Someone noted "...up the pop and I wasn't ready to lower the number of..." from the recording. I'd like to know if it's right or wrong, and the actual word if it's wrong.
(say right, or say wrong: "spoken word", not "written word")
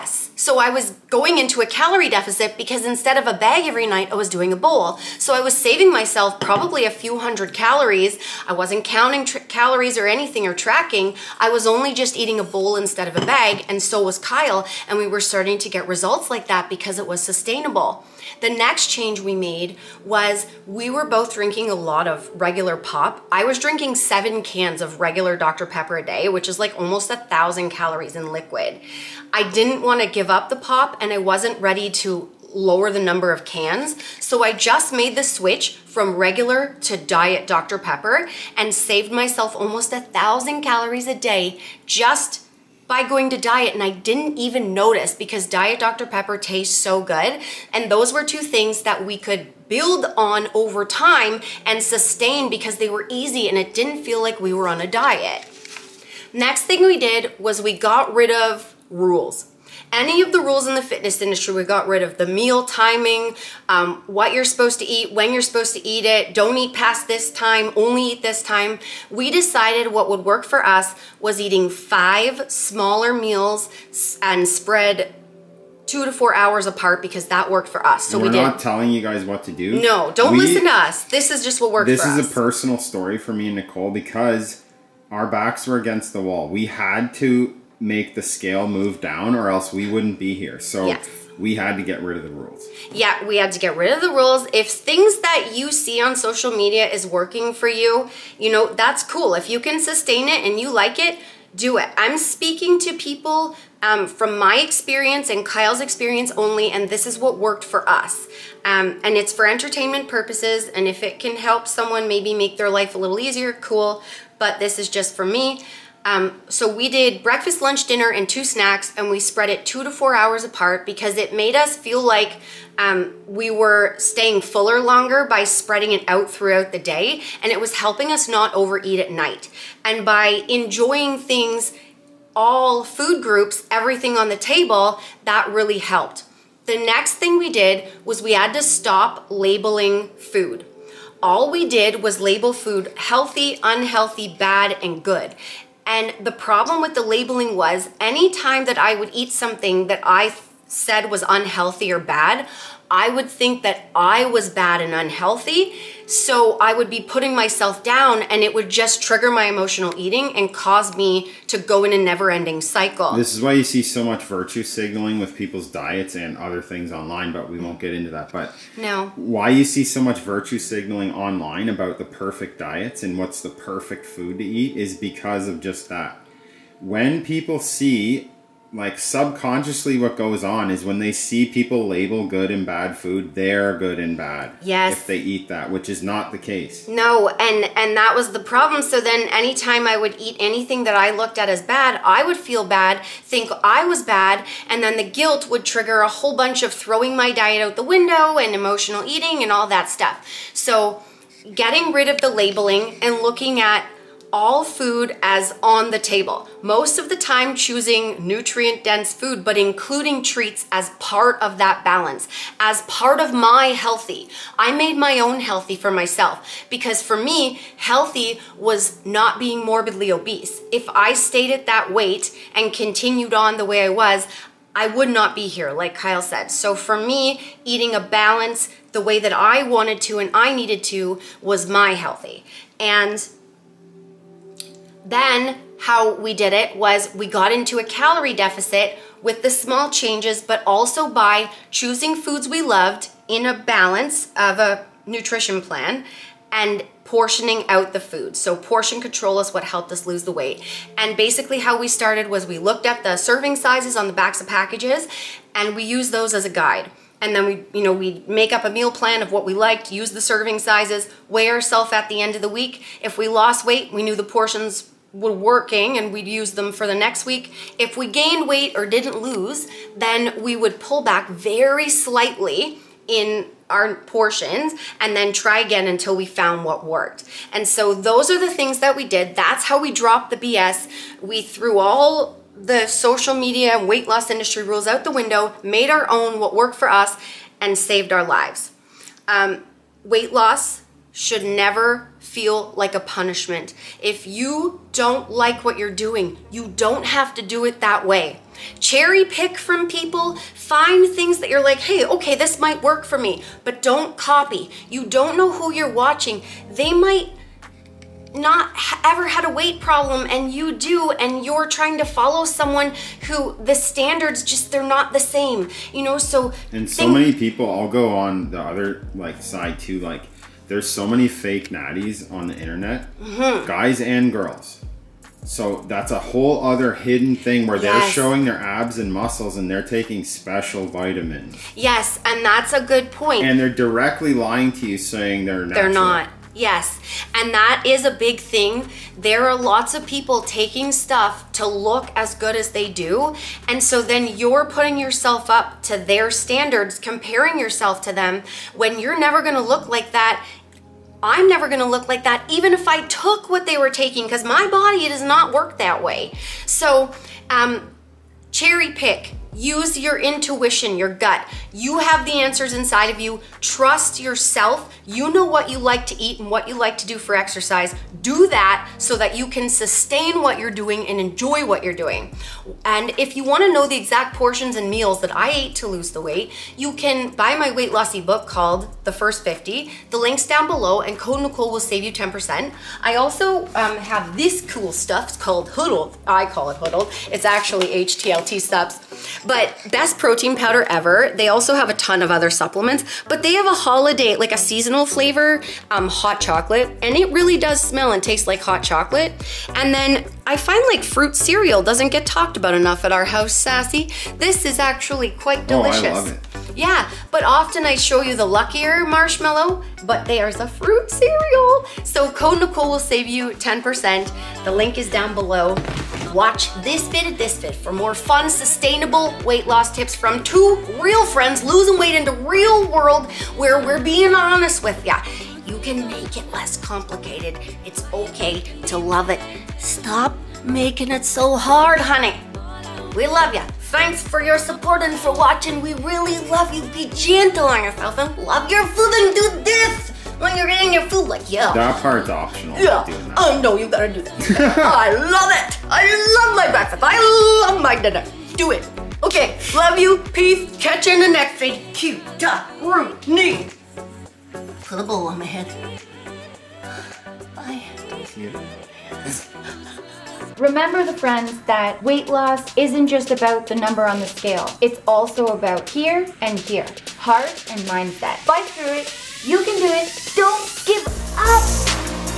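right.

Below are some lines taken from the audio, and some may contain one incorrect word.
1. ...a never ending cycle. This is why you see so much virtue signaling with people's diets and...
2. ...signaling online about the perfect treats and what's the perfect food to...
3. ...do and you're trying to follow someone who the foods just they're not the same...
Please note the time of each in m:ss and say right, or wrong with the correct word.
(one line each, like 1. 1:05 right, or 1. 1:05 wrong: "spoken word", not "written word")
1. 2:41 right
2. 2:50 wrong: "diets", not "treats"
3. 5:10 wrong: "standards", not "foods".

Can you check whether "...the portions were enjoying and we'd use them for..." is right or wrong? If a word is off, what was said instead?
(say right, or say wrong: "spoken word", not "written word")
wrong: "working", not "enjoying".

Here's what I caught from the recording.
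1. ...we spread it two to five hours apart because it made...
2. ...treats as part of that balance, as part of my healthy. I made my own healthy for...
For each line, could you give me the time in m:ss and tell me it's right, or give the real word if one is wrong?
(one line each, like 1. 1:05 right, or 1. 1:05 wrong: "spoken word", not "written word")
1. 1:59 wrong: "four", not "five"
2. 3:30 right.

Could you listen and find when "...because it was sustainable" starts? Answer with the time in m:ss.
0:16.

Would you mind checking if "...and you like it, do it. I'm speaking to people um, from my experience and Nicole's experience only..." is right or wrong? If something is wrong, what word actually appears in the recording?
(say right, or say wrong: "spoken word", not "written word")
wrong: "Kyle", not "Nicole".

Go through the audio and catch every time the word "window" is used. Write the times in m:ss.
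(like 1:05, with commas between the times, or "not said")
3:17, 4:45.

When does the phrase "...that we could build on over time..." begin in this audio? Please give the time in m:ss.
0:48.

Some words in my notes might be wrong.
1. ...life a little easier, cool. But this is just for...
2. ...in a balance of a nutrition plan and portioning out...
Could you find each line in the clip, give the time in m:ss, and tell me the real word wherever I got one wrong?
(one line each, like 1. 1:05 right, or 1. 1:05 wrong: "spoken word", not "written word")
1. 1:52 right
2. 4:03 right.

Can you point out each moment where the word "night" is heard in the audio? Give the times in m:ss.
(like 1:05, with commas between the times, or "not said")
0:03, 2:09.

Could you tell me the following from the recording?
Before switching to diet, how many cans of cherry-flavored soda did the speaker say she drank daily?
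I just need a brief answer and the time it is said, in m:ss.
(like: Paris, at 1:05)
7, at 0:23.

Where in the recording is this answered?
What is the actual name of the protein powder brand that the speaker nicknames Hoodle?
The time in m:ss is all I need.
6:28.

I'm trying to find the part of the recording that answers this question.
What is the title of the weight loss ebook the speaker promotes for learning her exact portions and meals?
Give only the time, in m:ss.
6:19.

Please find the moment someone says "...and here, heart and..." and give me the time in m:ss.
7:46.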